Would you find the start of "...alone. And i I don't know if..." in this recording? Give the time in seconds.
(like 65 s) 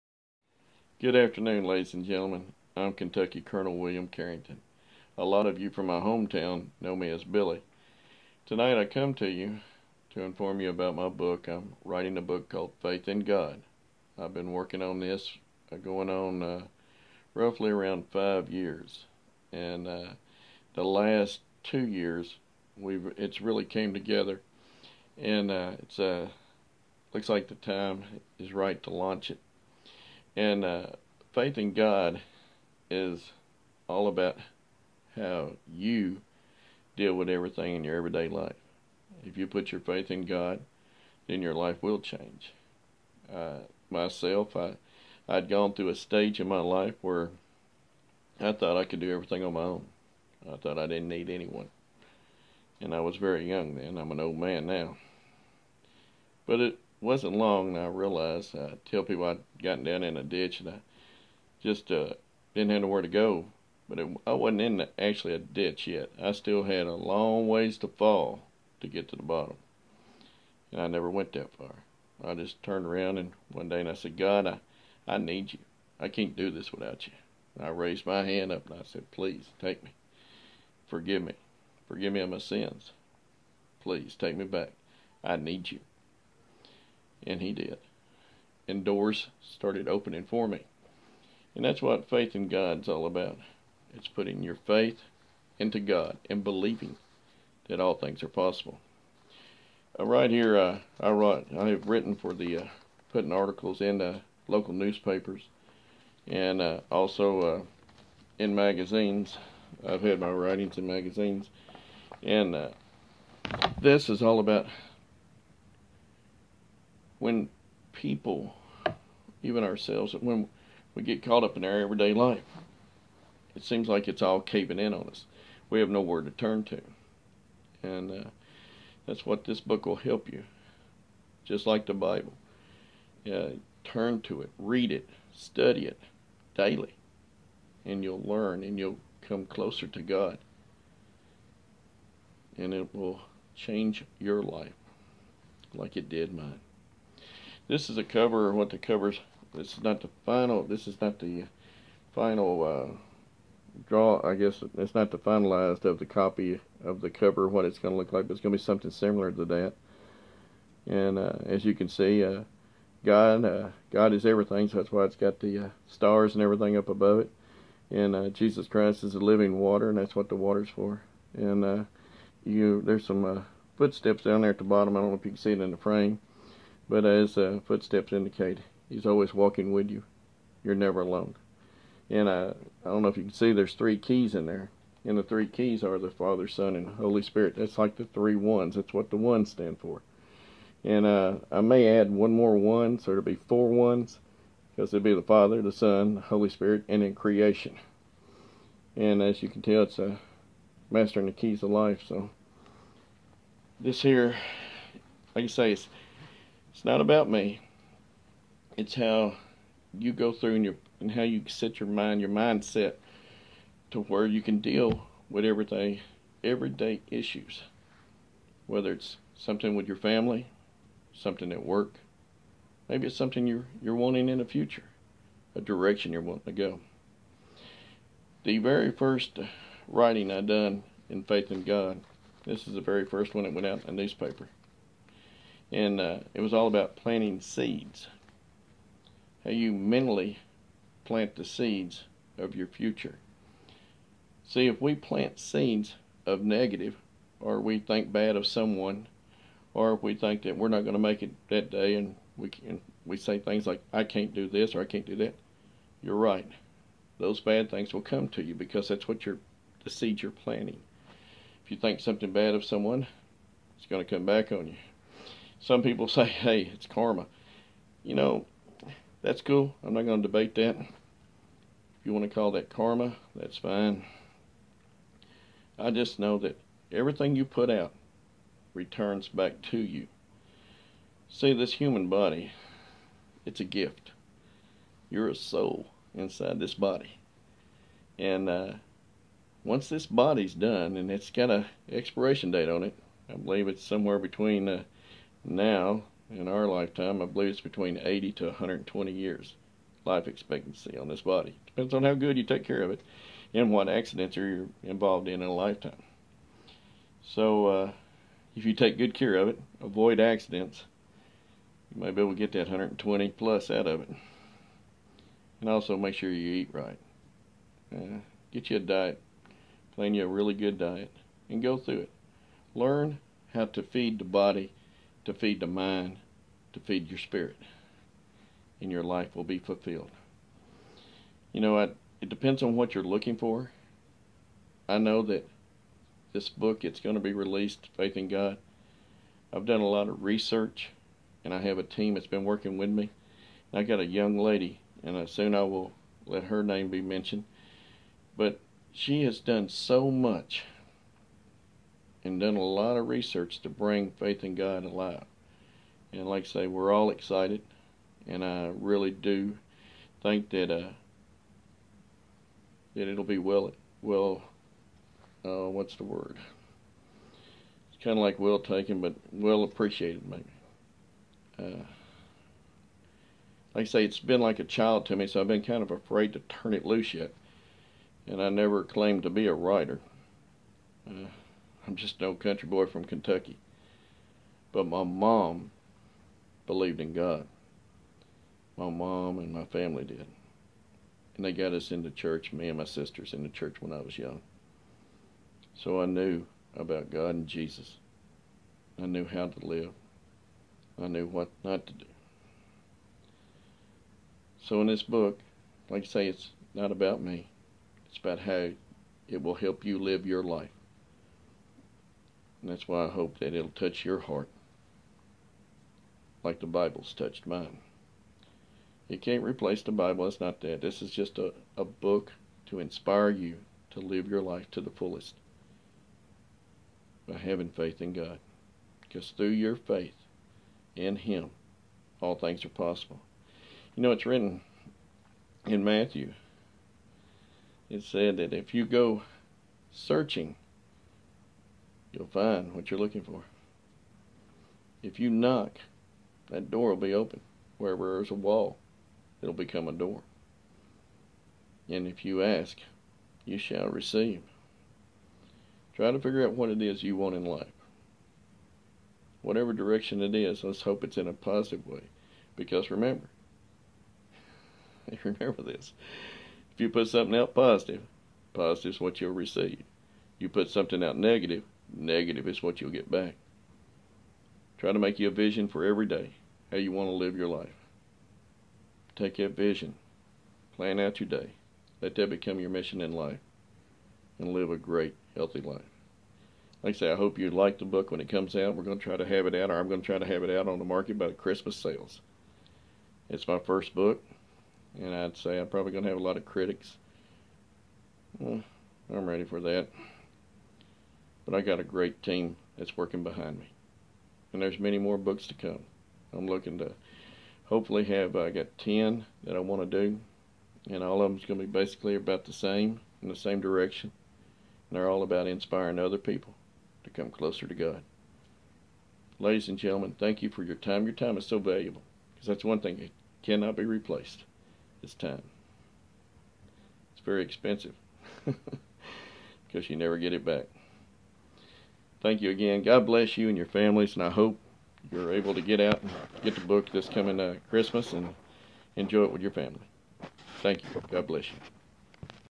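180 s.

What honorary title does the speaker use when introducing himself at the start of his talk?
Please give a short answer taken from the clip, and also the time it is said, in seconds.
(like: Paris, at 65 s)
Kentucky Colonel, at 2 s.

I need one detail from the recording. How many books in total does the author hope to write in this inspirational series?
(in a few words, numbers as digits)
10.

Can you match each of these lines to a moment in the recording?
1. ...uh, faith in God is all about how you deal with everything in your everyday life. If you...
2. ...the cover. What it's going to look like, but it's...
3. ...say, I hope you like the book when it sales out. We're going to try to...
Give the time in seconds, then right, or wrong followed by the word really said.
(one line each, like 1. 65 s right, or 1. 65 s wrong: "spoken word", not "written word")
1. 30 s right
2. 156 s right
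3. 486 s wrong: "comes", not "sales".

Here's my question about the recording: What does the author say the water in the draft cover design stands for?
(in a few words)
the living water.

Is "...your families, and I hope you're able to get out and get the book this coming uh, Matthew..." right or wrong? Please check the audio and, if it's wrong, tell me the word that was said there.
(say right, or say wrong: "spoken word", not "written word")
wrong: "Christmas", not "Matthew".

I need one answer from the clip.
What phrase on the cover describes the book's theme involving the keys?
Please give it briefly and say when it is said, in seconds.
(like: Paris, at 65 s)
mastering the keys of life, at 200 s.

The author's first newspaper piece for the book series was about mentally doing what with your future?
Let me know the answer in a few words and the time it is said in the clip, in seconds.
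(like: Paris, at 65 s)
planting seeds, at 236 s.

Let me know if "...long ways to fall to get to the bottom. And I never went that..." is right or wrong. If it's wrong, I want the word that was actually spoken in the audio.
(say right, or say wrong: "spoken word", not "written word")
right.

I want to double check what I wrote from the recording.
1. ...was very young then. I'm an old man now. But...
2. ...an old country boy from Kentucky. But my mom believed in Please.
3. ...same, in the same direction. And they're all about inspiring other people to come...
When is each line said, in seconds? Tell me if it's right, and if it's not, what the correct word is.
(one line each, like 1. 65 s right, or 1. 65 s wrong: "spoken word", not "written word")
1. 53 s right
2. 382 s wrong: "God", not "Please"
3. 512 s right.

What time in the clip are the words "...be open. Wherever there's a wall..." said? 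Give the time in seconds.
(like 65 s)
446 s.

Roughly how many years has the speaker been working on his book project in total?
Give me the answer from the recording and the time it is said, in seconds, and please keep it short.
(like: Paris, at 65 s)
5 years, at 18 s.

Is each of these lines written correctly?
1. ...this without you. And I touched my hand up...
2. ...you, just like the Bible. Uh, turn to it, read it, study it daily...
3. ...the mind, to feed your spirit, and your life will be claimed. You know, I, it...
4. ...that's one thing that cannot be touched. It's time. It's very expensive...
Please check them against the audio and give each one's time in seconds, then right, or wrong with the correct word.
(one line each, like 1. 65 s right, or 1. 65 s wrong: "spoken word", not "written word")
1. 76 s wrong: "raised", not "touched"
2. 130 s right
3. 325 s wrong: "fulfilled", not "claimed"
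4. 522 s wrong: "replaced", not "touched".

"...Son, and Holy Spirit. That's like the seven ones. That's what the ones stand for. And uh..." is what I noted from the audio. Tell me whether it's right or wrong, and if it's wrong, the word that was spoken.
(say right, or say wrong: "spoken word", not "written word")
wrong: "three", not "seven".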